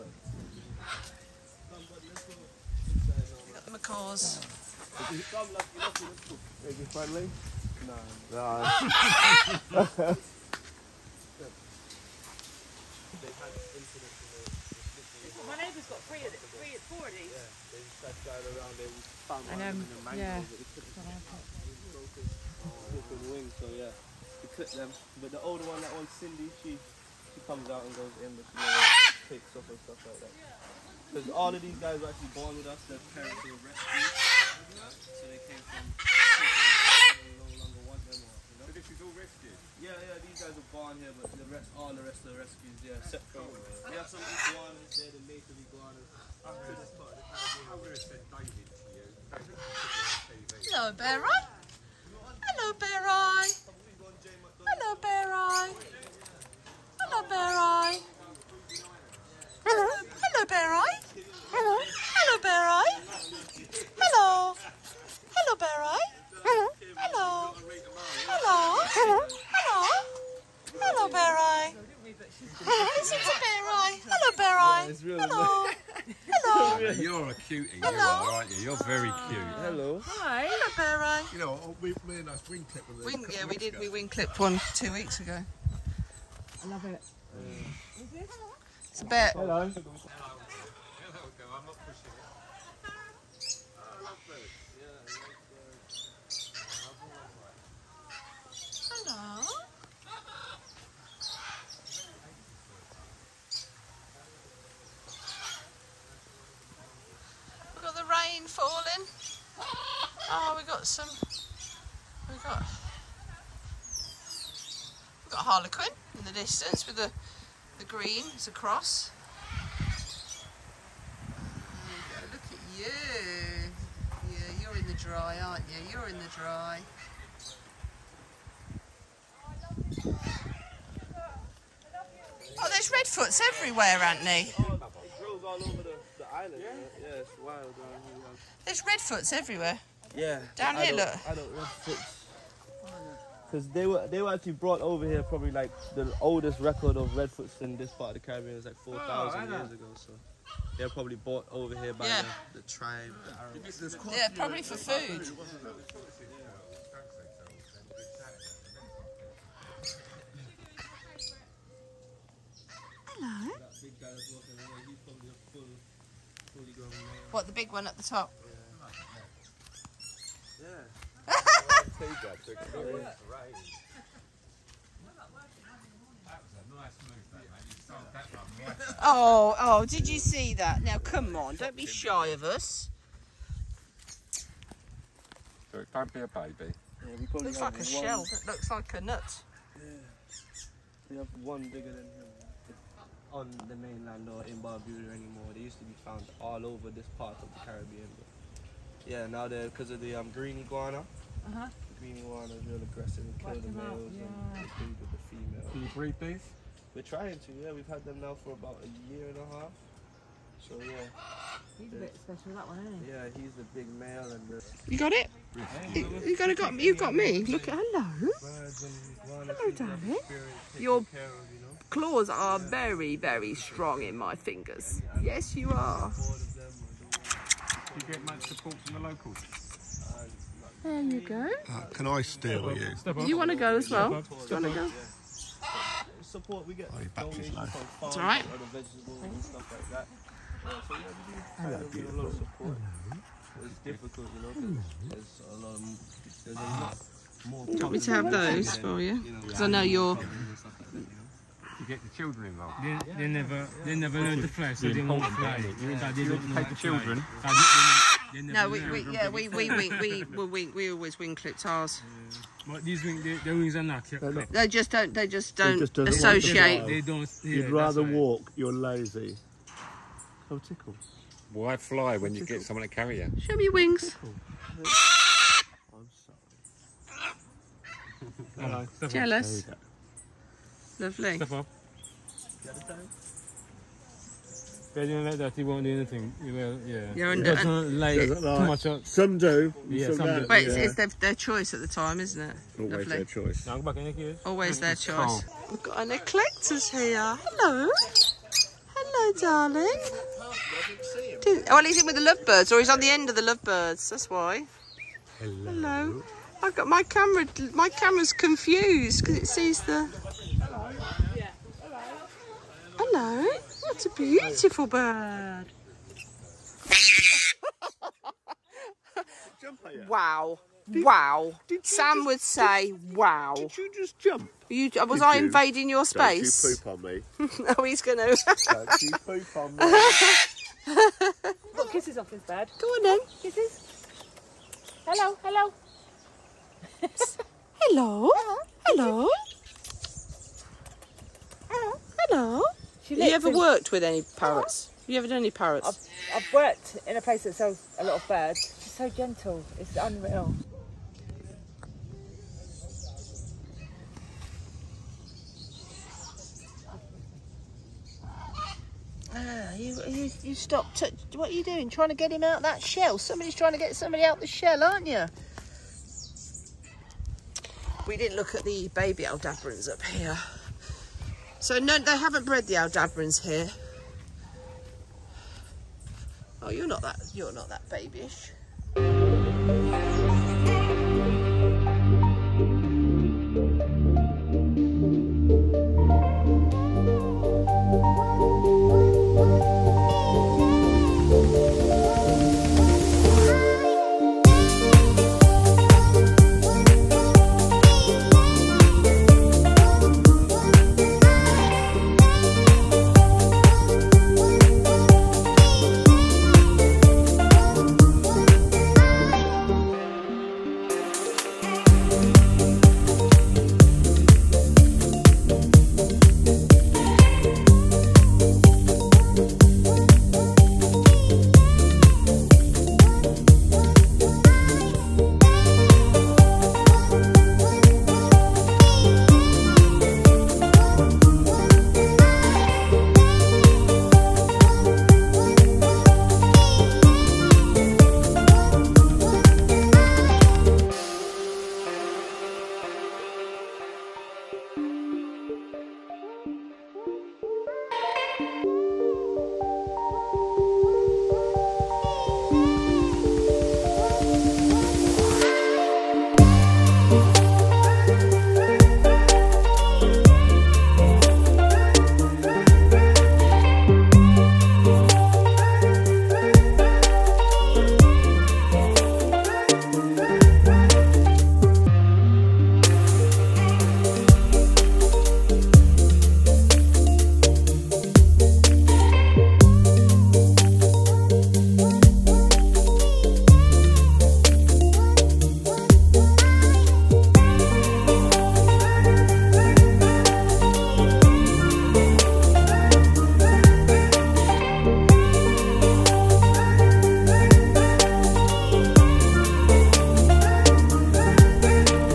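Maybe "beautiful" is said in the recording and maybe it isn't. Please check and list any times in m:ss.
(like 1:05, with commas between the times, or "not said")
4:01, 5:14.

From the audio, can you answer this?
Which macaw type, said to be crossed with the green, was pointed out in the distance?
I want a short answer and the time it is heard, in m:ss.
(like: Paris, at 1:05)
Harlequin, at 1:55.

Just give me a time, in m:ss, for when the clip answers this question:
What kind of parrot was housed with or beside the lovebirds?
4:56.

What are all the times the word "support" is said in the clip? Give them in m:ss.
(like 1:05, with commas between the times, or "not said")
3:48, 3:56.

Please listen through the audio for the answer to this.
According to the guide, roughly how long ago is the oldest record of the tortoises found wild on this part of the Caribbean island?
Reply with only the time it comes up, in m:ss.
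2:28.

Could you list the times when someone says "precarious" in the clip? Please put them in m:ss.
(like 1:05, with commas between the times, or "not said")
not said.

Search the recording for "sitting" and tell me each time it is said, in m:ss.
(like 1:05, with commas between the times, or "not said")
not said.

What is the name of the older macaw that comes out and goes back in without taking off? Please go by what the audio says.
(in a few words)
Cindy.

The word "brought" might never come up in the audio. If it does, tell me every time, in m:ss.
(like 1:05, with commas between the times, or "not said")
2:24, 2:31.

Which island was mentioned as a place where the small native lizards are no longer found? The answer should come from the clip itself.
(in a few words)
Barbuda.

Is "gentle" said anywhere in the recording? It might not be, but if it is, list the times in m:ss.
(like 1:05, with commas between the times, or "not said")
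5:49.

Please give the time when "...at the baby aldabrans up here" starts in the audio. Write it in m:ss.
6:08.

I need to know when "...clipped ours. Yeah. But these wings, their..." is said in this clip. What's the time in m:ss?
4:21.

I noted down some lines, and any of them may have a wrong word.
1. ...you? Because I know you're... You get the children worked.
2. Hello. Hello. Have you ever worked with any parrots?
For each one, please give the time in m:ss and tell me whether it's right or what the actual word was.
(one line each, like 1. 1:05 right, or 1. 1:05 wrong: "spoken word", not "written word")
1. 4:09 wrong: "involved", not "worked"
2. 5:41 right.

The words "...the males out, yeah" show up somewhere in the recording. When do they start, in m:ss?
3:23.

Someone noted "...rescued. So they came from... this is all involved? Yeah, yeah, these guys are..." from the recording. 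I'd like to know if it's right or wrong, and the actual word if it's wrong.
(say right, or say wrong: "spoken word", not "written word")
wrong: "rescued", not "involved".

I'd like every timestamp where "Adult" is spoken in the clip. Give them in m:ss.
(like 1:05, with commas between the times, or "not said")
2:21.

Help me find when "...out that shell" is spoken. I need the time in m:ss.
6:02.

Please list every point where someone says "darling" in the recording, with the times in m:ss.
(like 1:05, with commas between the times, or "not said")
3:39, 4:59.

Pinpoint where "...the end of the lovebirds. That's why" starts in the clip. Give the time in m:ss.
5:02.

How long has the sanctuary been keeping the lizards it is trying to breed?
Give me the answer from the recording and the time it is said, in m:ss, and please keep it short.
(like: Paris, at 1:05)
about a year and a half, at 3:28.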